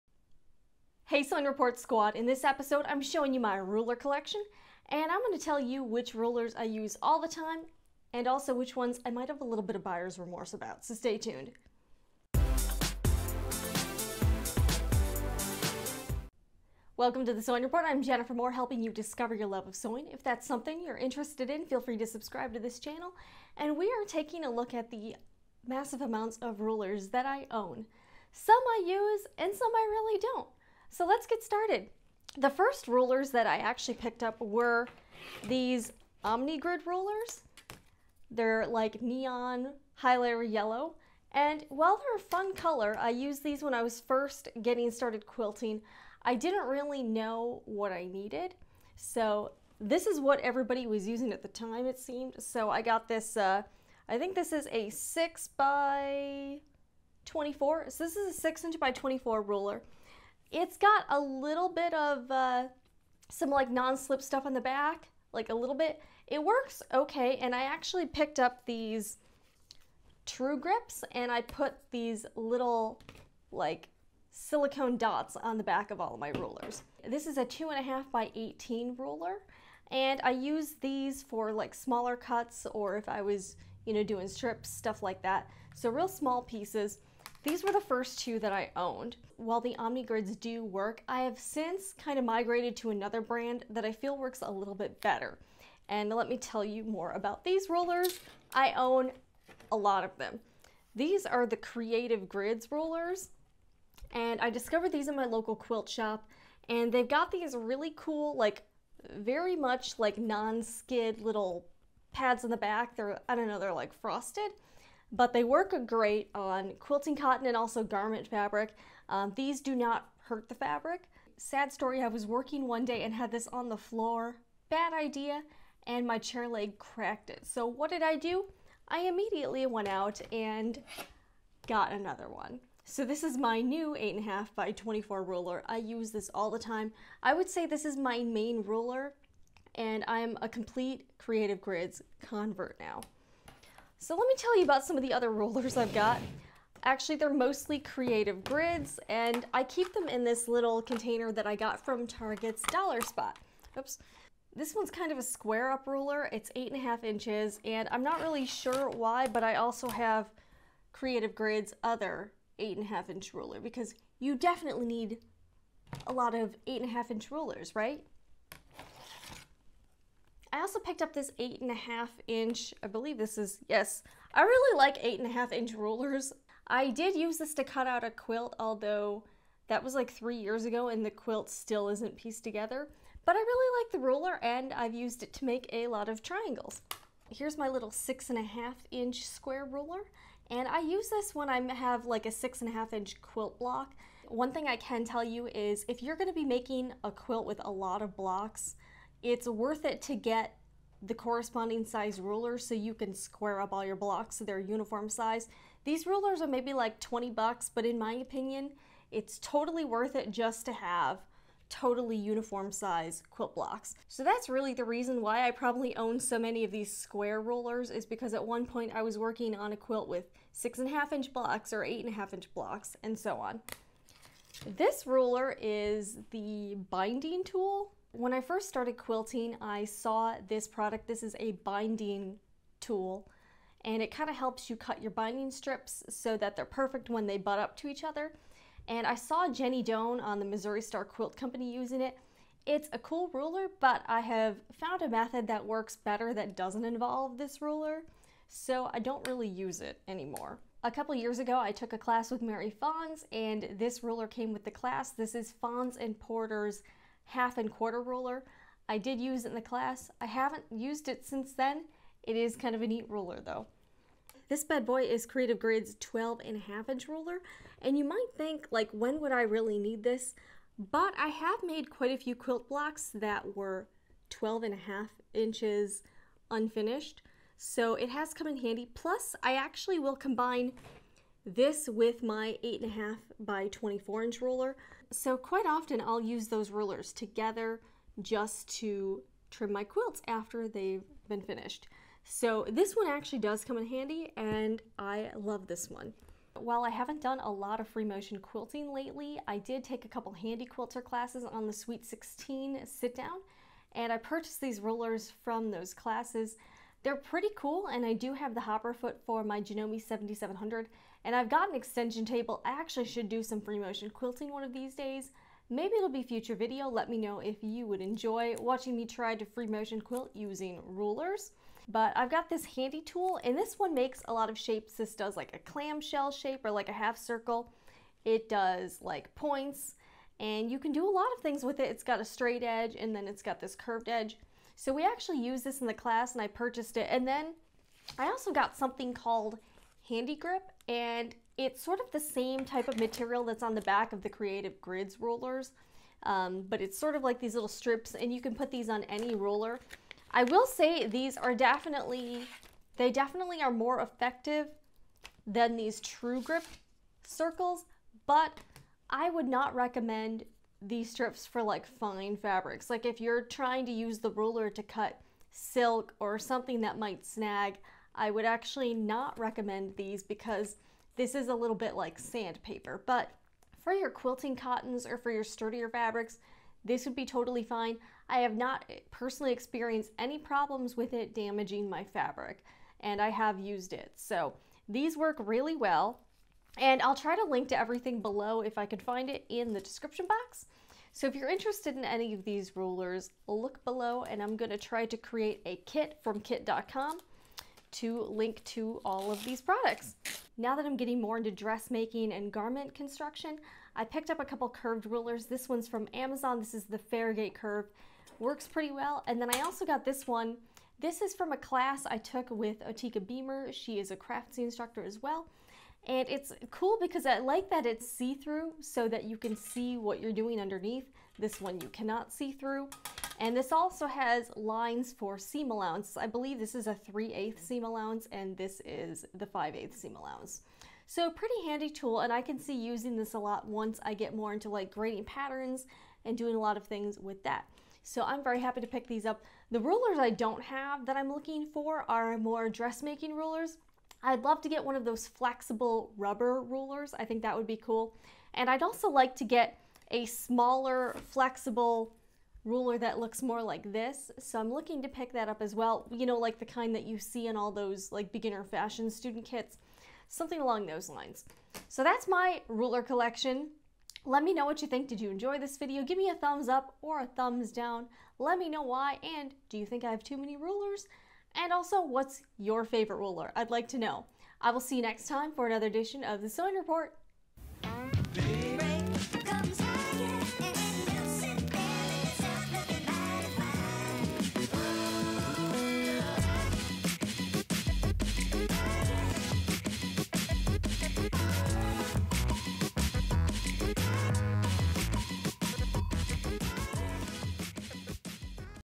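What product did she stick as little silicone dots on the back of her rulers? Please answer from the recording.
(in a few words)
True Grips.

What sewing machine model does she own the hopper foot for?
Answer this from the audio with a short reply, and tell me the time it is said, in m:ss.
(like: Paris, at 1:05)
Janome 7700, at 5:09.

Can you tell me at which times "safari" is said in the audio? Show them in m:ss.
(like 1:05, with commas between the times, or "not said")
not said.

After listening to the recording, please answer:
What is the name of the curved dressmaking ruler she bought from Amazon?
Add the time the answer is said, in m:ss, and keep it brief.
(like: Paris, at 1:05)
Fairgate curve, at 6:46.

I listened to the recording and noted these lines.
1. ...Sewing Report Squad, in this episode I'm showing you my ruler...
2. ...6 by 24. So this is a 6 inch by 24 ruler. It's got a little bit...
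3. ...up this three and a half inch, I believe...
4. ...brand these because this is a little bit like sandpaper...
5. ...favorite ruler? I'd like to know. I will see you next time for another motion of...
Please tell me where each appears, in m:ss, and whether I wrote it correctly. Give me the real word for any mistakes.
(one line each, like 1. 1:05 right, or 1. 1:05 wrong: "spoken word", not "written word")
1. 0:01 right
2. 0:54 right
3. 2:51 wrong: "eight", not "three"
4. 6:09 wrong: "recommend", not "brand"
5. 7:52 wrong: "edition", not "motion".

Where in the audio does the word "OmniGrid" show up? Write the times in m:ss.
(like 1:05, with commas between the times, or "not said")
0:36, 1:29.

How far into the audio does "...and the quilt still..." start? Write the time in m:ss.
3:00.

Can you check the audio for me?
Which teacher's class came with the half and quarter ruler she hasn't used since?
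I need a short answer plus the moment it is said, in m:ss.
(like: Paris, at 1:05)
Mary Fons, at 4:12.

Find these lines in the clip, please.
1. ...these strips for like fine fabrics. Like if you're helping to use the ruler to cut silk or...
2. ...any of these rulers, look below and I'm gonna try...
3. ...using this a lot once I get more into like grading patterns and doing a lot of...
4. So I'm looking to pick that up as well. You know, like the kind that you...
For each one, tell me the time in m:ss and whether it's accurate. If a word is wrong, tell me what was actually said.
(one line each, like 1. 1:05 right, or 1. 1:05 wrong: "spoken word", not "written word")
1. 6:00 wrong: "trying", not "helping"
2. 6:32 right
3. 7:12 right
4. 7:34 right.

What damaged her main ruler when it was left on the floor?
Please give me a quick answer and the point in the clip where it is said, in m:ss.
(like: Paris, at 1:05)
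chair leg, at 2:06.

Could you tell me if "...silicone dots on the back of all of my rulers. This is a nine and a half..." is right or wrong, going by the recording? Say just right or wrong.
wrong.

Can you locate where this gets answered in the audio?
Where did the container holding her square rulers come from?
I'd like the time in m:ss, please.
2:32.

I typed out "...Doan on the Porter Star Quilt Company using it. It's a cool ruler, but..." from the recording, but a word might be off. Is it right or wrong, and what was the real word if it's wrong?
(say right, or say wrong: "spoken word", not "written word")
wrong: "Missouri", not "Porter".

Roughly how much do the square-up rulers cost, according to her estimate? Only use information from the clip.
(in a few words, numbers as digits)
$20.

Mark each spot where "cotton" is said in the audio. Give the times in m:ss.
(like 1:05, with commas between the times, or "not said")
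1:57, 6:14.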